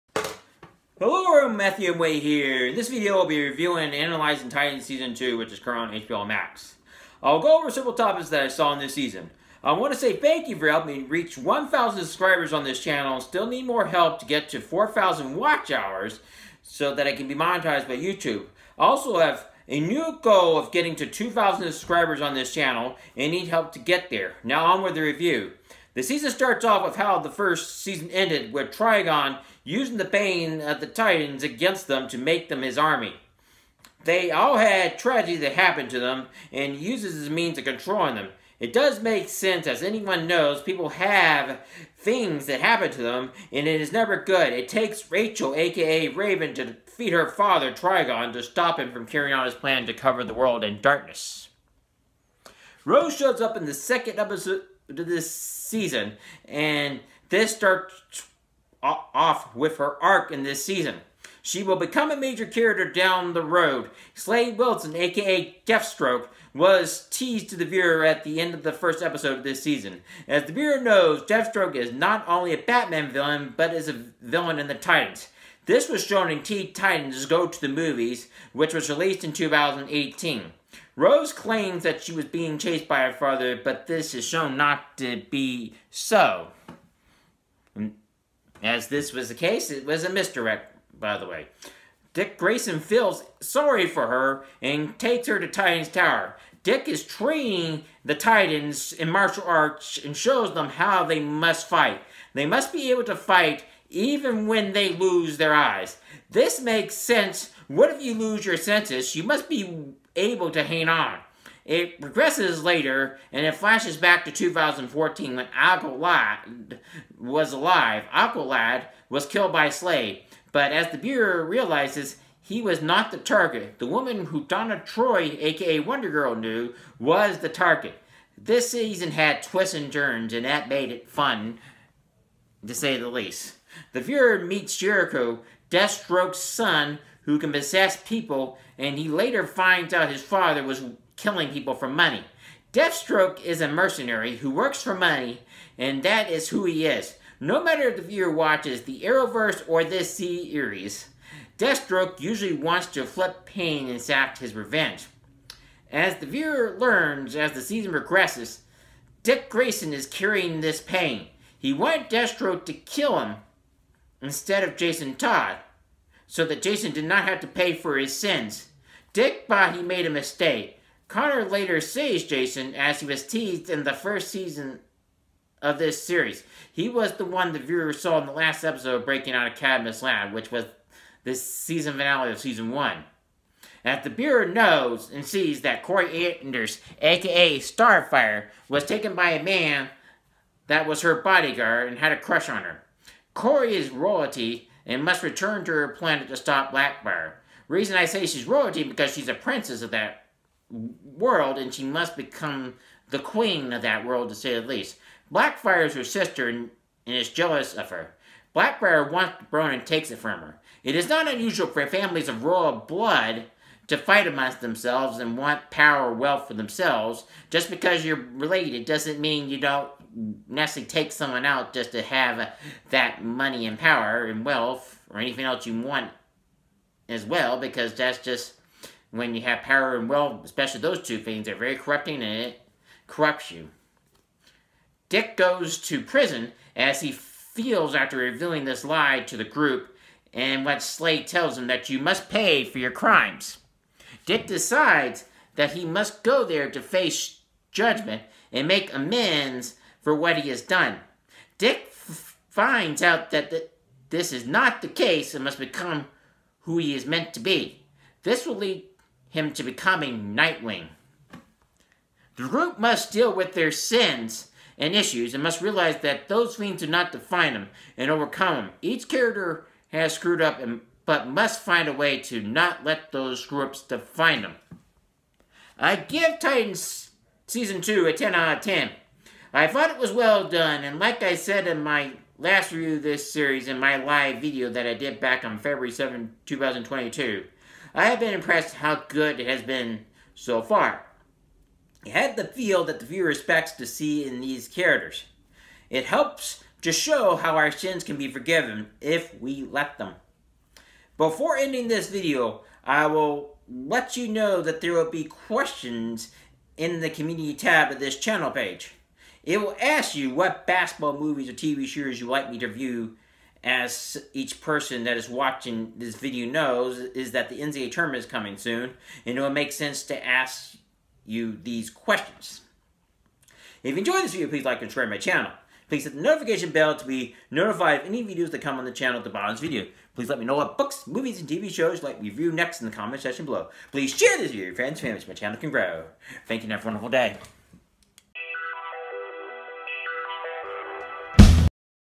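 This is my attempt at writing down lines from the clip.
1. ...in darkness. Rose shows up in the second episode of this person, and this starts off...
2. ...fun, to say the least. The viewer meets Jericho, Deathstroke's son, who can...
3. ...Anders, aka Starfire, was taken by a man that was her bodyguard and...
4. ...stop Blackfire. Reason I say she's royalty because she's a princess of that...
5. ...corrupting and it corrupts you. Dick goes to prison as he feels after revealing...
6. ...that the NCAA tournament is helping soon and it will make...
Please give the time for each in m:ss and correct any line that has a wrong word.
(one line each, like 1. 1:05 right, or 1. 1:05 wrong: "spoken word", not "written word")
1. 0:50 wrong: "season", not "person"
2. 2:11 right
3. 3:06 right
4. 3:16 right
5. 3:51 right
6. 5:17 wrong: "coming", not "helping".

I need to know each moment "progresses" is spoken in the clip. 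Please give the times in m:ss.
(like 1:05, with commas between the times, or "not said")
1:52, 2:37.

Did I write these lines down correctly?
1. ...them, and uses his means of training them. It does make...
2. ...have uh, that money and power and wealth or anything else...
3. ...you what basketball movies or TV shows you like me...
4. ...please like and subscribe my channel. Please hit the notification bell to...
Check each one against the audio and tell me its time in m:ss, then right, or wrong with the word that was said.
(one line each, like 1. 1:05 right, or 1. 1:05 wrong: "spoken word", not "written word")
1. 0:35 wrong: "controlling", not "training"
2. 3:42 right
3. 5:10 right
4. 5:24 right.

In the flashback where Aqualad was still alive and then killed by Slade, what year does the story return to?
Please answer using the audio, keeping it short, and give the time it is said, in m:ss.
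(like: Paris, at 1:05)
2014, at 1:54.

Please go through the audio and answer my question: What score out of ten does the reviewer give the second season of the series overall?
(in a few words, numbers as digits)
10.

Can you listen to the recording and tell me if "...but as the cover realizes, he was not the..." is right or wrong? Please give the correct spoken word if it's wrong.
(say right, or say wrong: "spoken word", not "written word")
wrong: "viewer", not "cover".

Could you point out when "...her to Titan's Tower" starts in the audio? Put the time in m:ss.
1:35.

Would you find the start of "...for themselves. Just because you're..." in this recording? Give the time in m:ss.
3:36.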